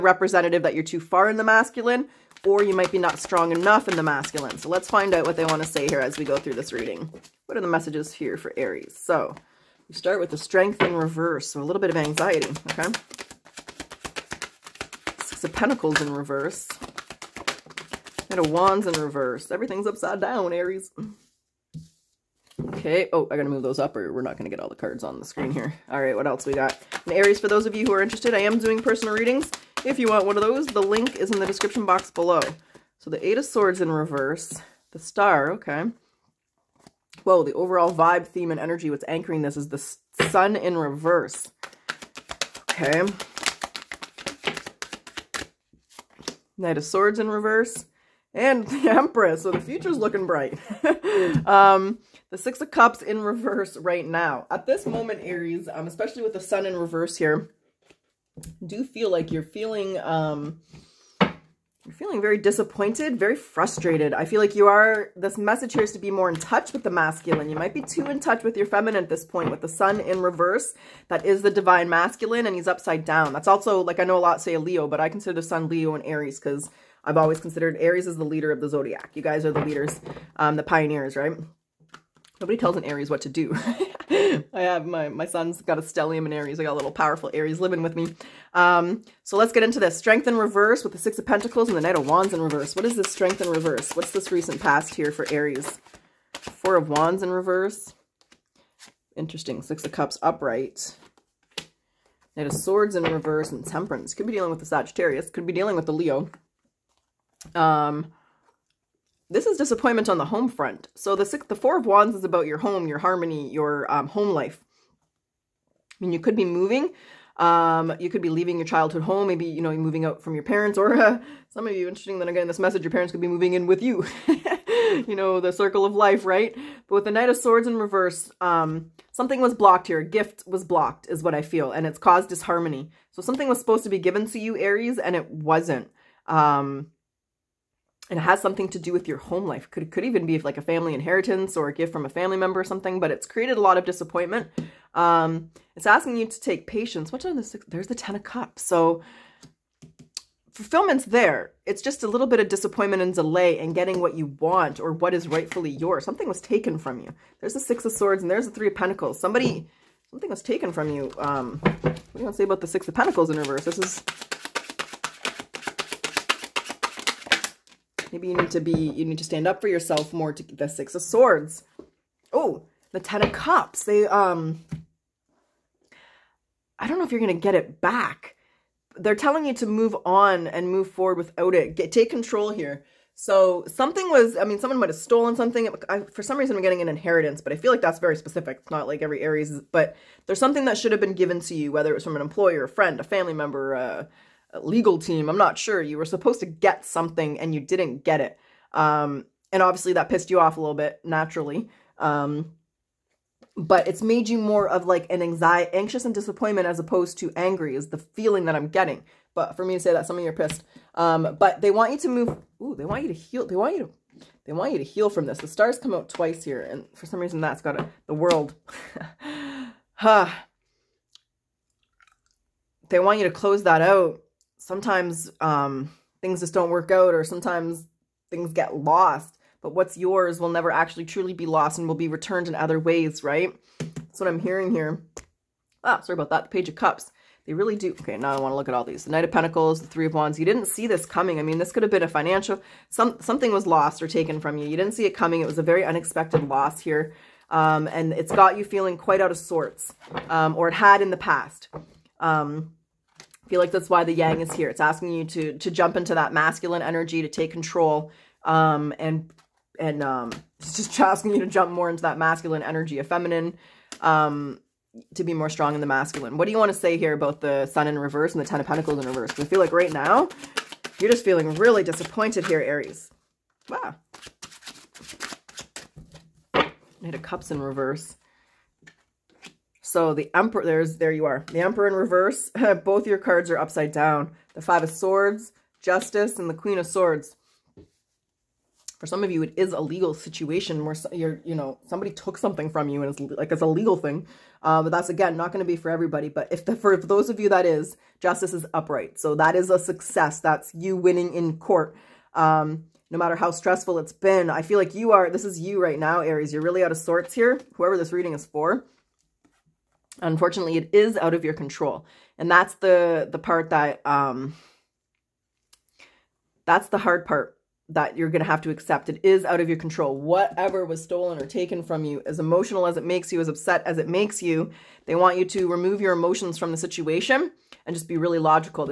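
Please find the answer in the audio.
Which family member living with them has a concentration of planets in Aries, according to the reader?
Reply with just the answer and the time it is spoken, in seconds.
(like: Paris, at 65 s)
Son, at 85 s.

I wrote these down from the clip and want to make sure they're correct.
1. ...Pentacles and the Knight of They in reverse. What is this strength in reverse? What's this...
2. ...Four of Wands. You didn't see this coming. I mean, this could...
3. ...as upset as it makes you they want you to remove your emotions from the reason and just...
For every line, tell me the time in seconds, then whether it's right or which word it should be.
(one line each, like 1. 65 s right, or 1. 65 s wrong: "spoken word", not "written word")
1. 91 s wrong: "Wands", not "They"
2. 239 s wrong: "Three", not "Four"
3. 323 s wrong: "situation", not "reason".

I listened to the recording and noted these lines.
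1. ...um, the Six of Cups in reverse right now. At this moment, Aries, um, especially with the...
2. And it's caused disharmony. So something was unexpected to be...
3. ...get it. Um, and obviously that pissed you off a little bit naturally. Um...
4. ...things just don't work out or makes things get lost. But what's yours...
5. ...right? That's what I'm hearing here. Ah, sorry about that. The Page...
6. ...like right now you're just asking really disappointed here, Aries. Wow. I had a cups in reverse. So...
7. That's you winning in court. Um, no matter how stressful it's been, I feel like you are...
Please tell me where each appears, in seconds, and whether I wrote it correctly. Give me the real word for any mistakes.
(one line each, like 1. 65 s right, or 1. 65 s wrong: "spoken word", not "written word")
1. 51 s right
2. 131 s wrong: "supposed", not "unexpected"
3. 198 s right
4. 226 s wrong: "sometimes", not "makes"
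5. 233 s right
6. 269 s wrong: "feeling", not "asking"
7. 300 s right.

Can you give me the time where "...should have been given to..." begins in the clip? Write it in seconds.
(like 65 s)
190 s.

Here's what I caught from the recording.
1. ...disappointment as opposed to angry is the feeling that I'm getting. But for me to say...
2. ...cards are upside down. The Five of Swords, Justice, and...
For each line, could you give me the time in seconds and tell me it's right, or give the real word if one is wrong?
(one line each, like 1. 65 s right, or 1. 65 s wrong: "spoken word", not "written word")
1. 206 s right
2. 283 s right.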